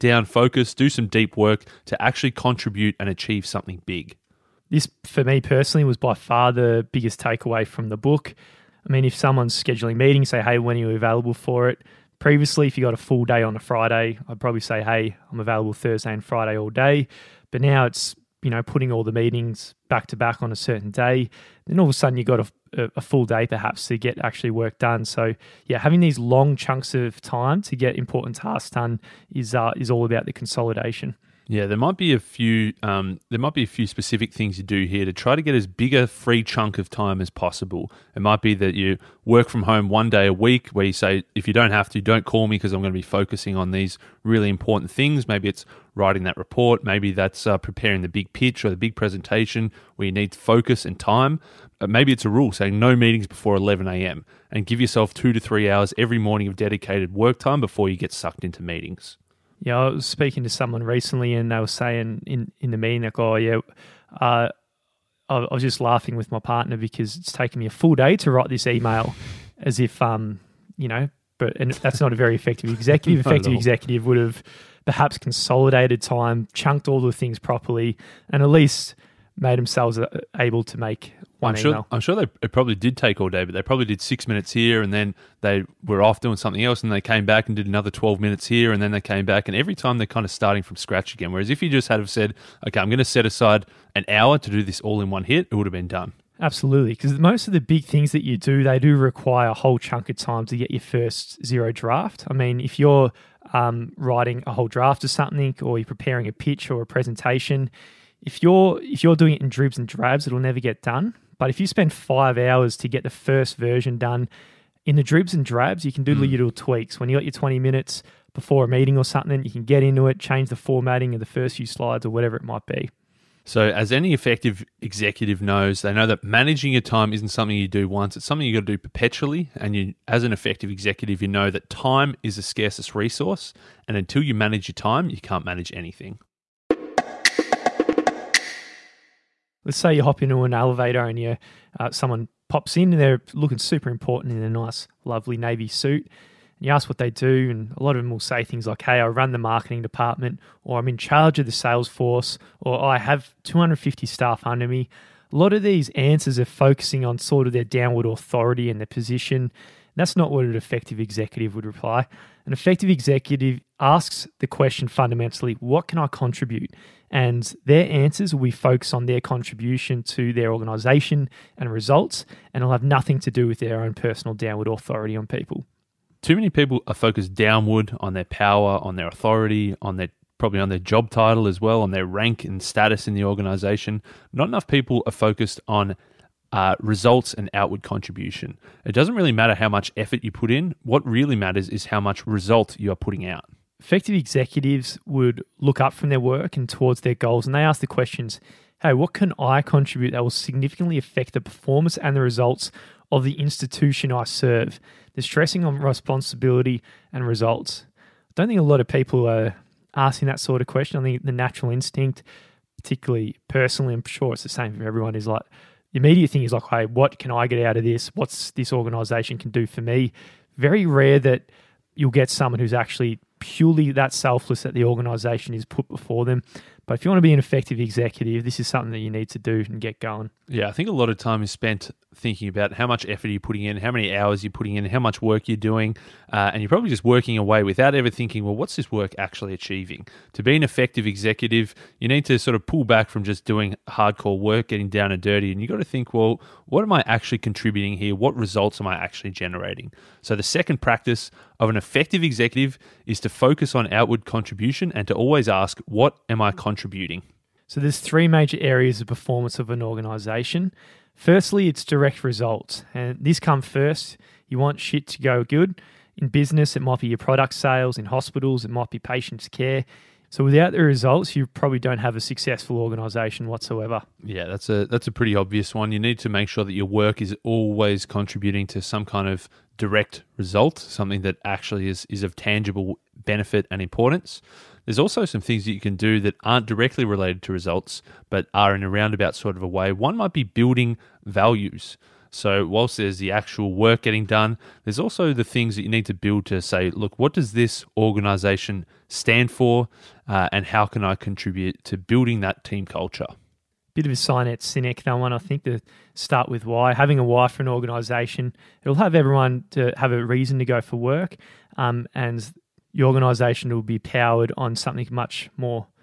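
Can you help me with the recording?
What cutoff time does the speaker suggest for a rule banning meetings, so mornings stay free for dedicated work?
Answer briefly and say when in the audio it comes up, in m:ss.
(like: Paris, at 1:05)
11 a.m., at 0:53.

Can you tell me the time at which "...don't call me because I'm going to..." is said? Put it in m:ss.
0:41.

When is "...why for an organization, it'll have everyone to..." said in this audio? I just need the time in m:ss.
5:07.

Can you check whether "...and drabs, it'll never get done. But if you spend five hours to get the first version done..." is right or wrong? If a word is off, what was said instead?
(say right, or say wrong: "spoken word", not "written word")
right.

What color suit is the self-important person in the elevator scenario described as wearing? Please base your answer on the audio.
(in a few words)
navy.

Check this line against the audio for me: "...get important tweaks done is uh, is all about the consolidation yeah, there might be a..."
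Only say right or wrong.
wrong.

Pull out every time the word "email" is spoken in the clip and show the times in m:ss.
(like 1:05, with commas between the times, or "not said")
1:08, 1:21.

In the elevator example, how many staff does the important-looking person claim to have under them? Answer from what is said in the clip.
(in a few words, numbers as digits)
250.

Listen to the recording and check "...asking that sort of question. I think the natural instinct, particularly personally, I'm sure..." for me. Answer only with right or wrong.
right.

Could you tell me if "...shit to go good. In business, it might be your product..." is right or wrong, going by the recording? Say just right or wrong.
right.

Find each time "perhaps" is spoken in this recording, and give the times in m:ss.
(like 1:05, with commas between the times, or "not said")
0:23, 1:14.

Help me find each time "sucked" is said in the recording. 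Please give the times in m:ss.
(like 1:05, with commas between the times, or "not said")
0:58.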